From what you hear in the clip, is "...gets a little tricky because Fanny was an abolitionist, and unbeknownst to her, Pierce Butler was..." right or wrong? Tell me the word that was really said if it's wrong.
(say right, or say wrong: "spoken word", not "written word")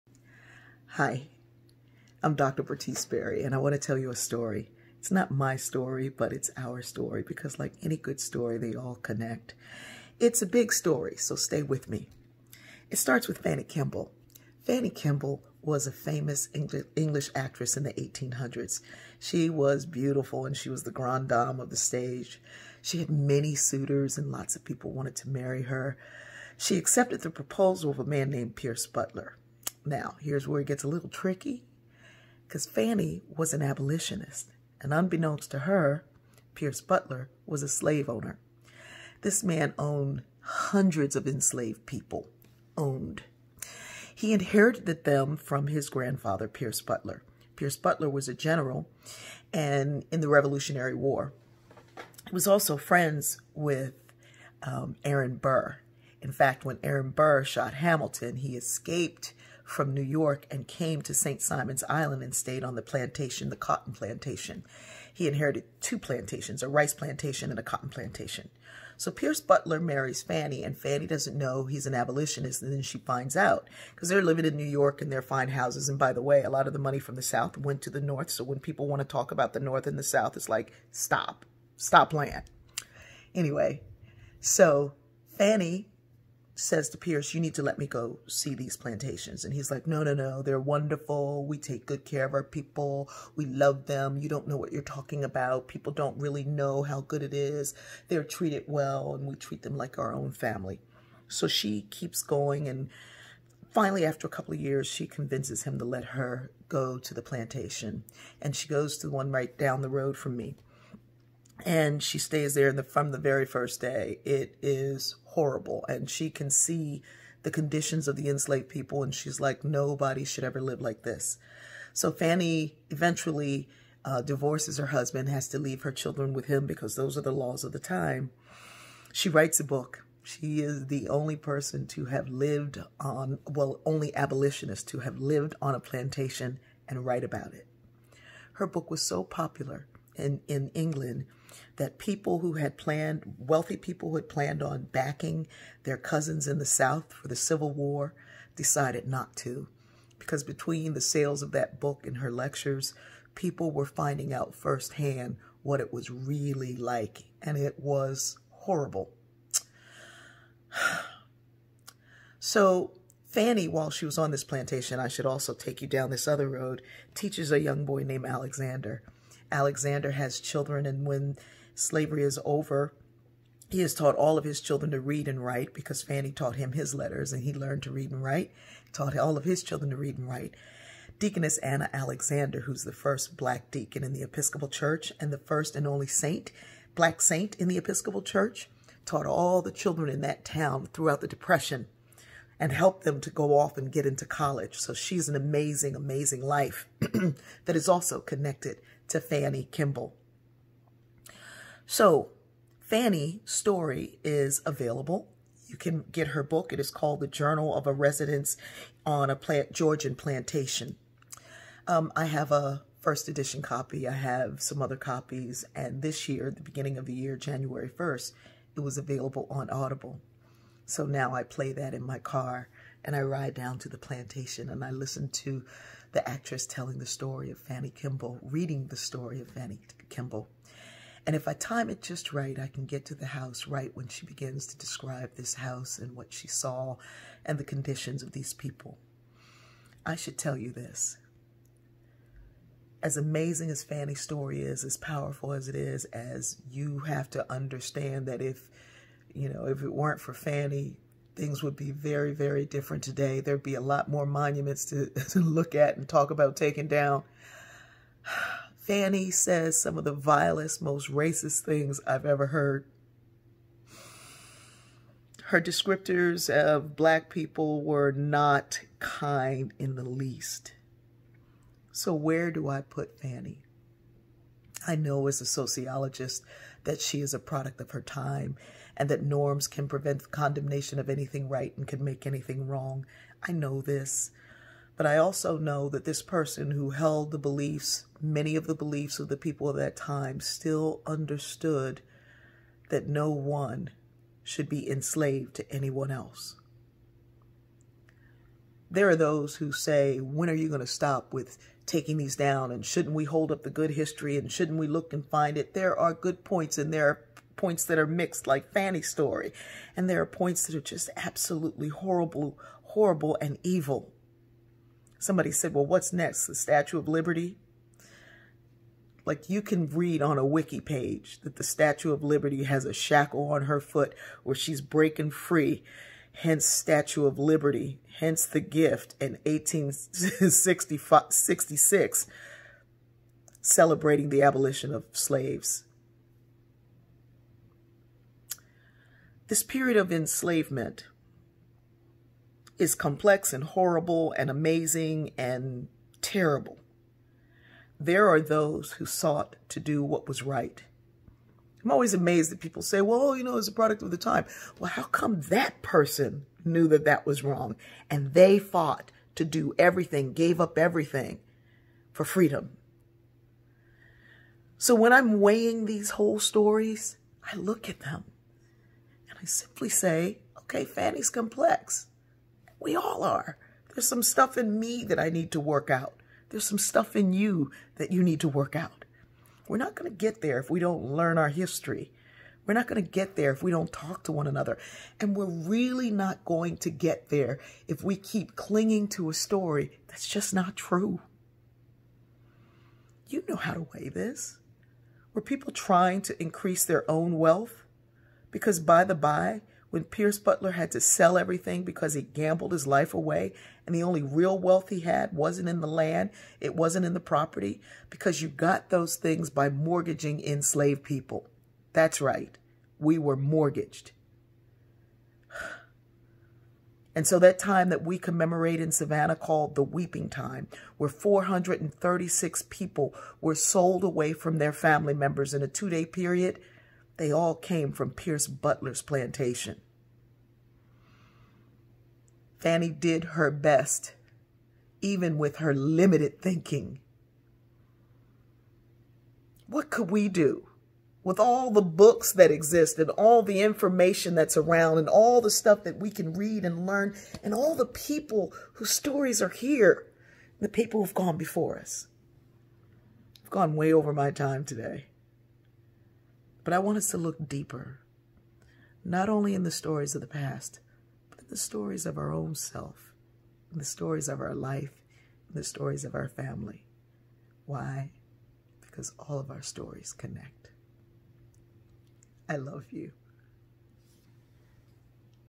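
right.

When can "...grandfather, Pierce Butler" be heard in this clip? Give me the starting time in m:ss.
0:45.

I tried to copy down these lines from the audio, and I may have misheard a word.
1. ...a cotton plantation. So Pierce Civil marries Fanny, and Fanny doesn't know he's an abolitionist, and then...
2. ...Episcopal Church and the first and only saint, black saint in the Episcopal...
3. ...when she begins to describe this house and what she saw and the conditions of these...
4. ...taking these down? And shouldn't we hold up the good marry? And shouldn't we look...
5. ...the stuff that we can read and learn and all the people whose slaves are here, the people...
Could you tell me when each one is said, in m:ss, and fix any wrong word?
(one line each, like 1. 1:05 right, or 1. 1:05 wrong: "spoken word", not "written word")
1. 1:07 wrong: "Butler", not "Civil"
2. 3:04 right
3. 3:53 right
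4. 5:01 wrong: "history", not "marry"
5. 7:25 wrong: "stories", not "slaves".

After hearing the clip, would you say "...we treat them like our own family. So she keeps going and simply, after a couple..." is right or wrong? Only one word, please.
wrong.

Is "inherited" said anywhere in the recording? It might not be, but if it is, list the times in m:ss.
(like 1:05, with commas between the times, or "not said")
0:44, 1:05.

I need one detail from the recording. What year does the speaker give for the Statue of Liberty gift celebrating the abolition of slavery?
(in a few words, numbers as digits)
1866.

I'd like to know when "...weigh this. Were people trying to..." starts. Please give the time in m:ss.
6:33.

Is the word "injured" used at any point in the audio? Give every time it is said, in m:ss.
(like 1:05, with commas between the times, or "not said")
not said.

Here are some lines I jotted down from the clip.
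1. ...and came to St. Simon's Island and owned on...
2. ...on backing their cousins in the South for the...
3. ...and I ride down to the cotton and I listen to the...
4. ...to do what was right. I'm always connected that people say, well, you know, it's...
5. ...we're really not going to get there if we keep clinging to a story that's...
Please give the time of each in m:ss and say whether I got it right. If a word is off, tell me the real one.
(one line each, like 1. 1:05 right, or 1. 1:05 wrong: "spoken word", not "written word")
1. 1:00 wrong: "stayed", not "owned"
2. 2:24 right
3. 3:43 wrong: "plantation", not "cotton"
4. 5:49 wrong: "amazed", not "connected"
5. 6:25 right.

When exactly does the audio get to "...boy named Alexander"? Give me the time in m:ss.
2:47.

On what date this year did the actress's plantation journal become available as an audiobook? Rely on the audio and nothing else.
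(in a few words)
January 1st.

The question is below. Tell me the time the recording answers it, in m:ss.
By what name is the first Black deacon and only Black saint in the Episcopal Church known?
3:01.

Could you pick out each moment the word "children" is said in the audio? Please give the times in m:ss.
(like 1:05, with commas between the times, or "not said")
2:05, 2:50, 2:54, 2:59, 3:09.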